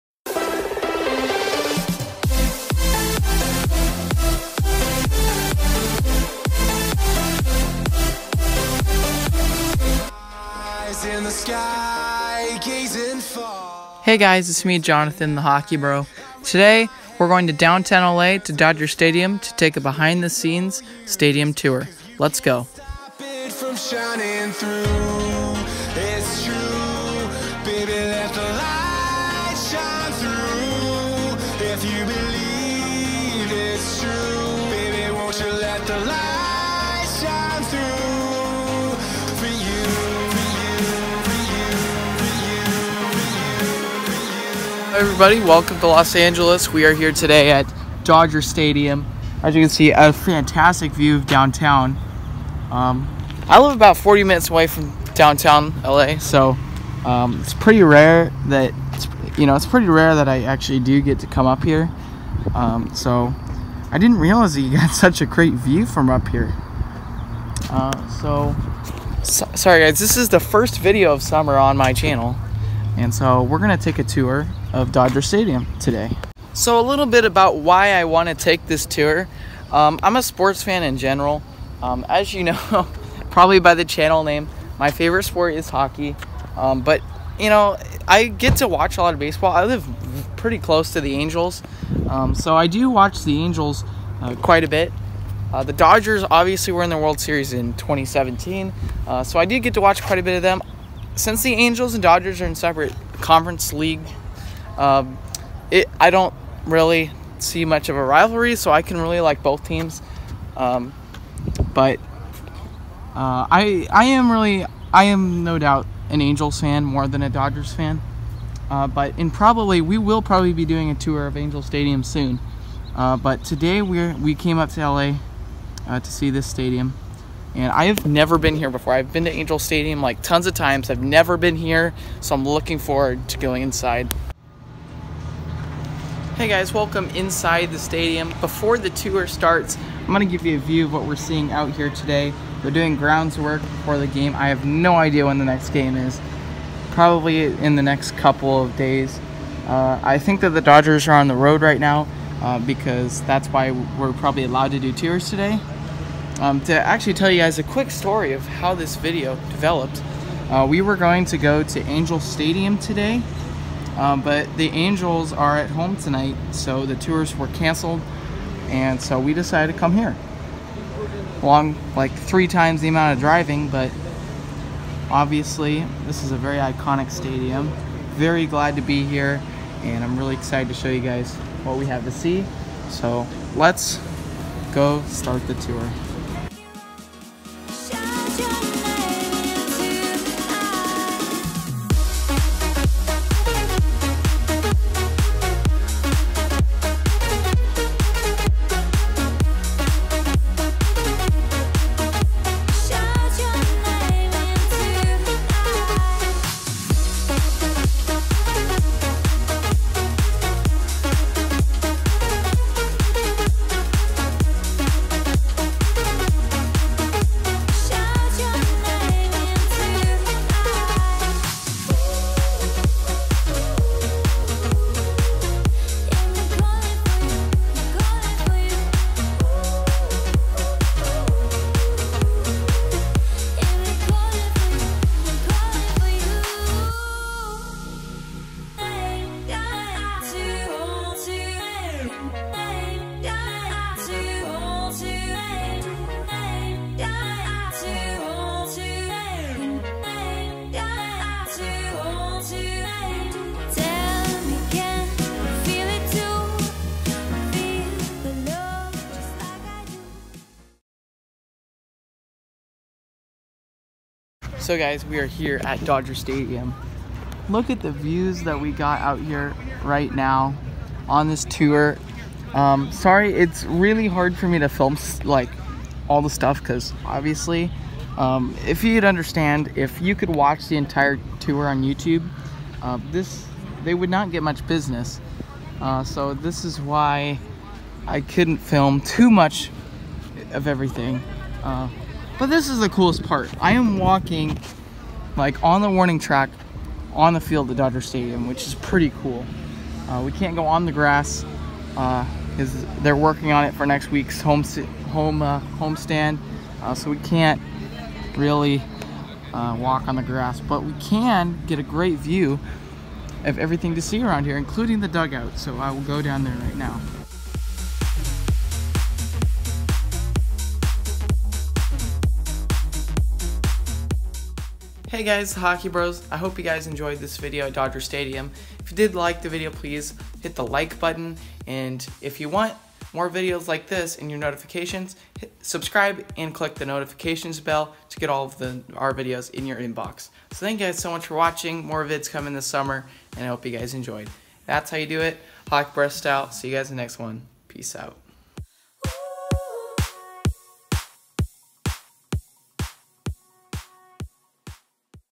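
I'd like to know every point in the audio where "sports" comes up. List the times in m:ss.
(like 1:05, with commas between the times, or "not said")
1:20, 1:25.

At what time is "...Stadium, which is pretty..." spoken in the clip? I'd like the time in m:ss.
4:58.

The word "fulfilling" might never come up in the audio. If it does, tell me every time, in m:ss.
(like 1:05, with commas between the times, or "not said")
not said.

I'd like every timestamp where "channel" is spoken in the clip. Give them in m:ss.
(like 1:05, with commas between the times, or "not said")
1:11, 1:23.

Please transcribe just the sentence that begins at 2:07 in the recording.
And I have never been here before.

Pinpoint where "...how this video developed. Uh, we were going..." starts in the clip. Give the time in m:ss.
2:38.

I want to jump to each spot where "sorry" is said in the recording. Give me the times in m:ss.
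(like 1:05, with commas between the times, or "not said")
1:09, 4:32.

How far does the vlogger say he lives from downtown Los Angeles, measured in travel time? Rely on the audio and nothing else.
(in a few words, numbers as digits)
40 minutes.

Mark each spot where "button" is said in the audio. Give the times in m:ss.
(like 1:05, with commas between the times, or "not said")
5:31.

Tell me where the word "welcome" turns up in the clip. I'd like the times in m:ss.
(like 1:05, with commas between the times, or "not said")
0:45, 2:16.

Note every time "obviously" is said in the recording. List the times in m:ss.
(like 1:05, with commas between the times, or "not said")
1:36, 2:55, 4:37.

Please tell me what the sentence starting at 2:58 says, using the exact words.
Very glad to be here, and I'm really excited to show you guys what we have to see.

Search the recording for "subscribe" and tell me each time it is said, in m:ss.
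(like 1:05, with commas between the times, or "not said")
5:35.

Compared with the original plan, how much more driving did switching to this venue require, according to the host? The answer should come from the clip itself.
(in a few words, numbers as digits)
three times.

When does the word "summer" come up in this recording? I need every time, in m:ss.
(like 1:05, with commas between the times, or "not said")
1:11, 5:42.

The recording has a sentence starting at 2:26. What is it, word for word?
Probably in the next couple of days.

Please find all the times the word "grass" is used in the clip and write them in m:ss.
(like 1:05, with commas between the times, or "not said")
5:00, 5:10.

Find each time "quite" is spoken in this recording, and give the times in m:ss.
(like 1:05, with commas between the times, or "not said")
1:34, 1:40.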